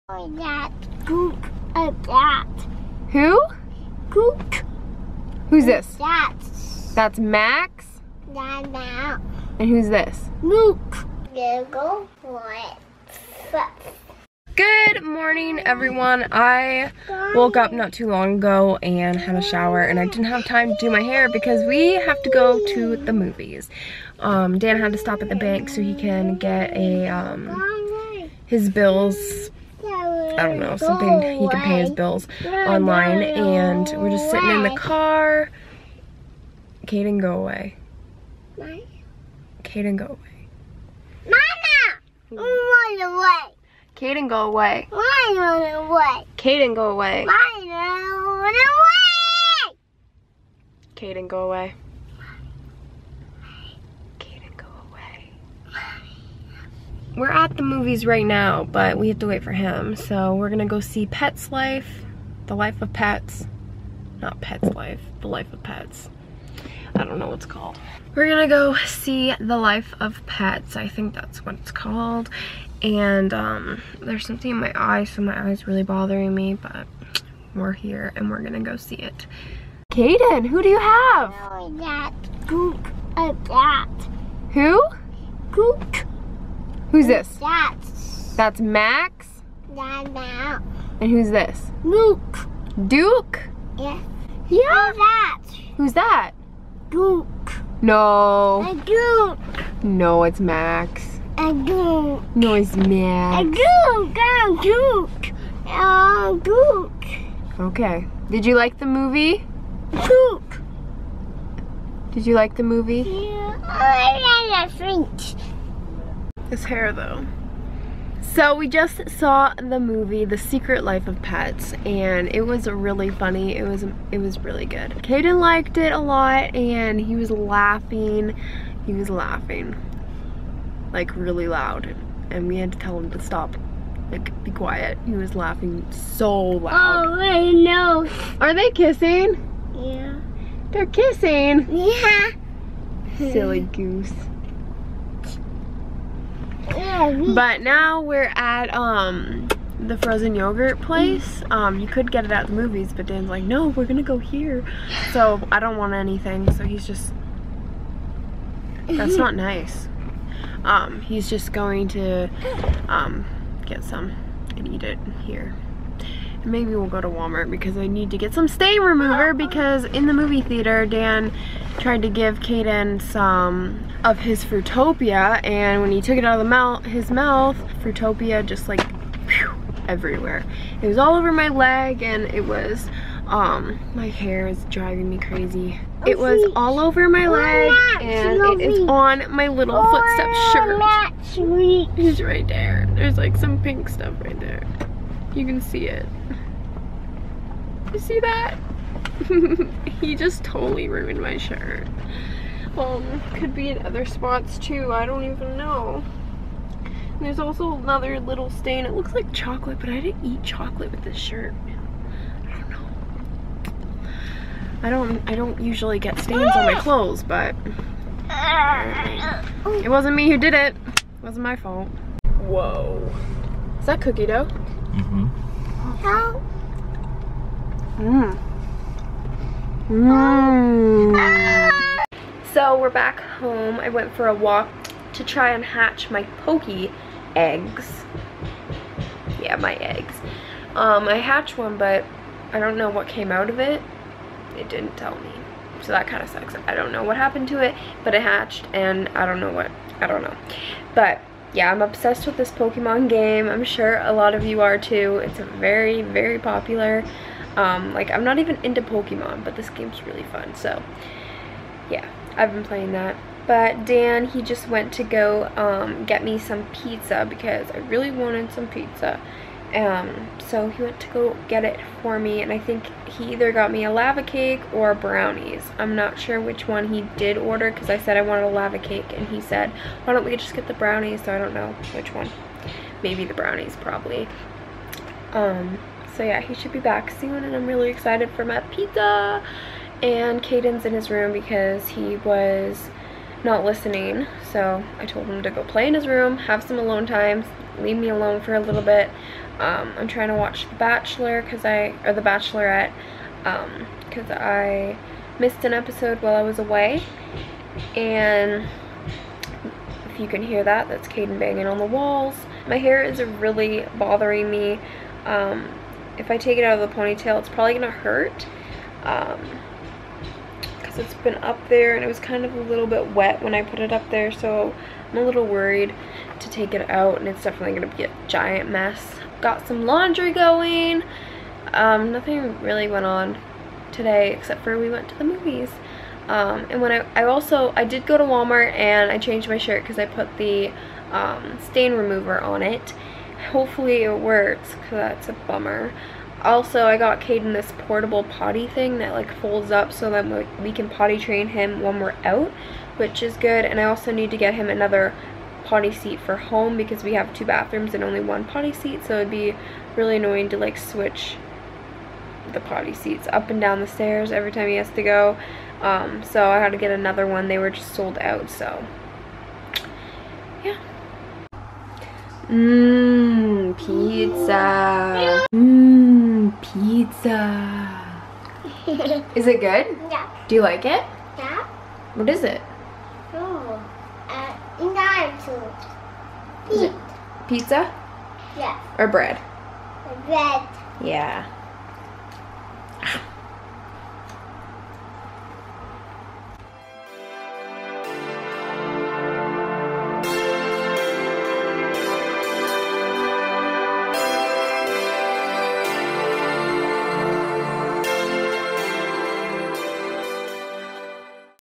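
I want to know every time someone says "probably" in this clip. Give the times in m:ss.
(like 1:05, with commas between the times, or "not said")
4:43, 5:17.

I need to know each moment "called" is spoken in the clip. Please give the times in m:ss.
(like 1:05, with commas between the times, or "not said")
1:07, 1:11.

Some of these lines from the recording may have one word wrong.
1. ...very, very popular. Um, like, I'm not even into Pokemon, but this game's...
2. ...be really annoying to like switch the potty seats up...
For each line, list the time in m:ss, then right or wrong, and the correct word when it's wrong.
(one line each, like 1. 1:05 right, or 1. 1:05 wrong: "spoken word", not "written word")
1. 4:15 right
2. 5:59 right.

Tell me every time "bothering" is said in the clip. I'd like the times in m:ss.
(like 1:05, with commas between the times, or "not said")
1:15, 5:13.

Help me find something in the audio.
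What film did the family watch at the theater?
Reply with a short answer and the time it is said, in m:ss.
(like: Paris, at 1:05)
The Secret Life of Pets, at 2:00.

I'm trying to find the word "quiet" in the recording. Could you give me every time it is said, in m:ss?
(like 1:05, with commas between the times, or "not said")
2:14.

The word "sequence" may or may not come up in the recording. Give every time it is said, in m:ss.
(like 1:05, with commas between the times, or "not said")
not said.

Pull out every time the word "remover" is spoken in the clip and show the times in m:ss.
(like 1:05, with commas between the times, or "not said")
2:48, 5:41.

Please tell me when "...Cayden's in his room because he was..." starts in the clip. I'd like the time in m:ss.
4:50.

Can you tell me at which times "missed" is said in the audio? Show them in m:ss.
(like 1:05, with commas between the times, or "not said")
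5:05.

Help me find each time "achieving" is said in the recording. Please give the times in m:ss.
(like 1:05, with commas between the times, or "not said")
not said.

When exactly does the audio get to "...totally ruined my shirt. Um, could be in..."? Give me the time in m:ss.
3:20.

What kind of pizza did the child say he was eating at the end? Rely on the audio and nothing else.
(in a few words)
Nacho.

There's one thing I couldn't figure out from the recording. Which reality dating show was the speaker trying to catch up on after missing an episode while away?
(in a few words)
The Bachelorette.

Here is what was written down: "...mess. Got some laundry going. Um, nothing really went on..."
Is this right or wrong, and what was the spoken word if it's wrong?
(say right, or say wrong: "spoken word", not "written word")
right.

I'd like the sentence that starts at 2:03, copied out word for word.
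It was it was really good.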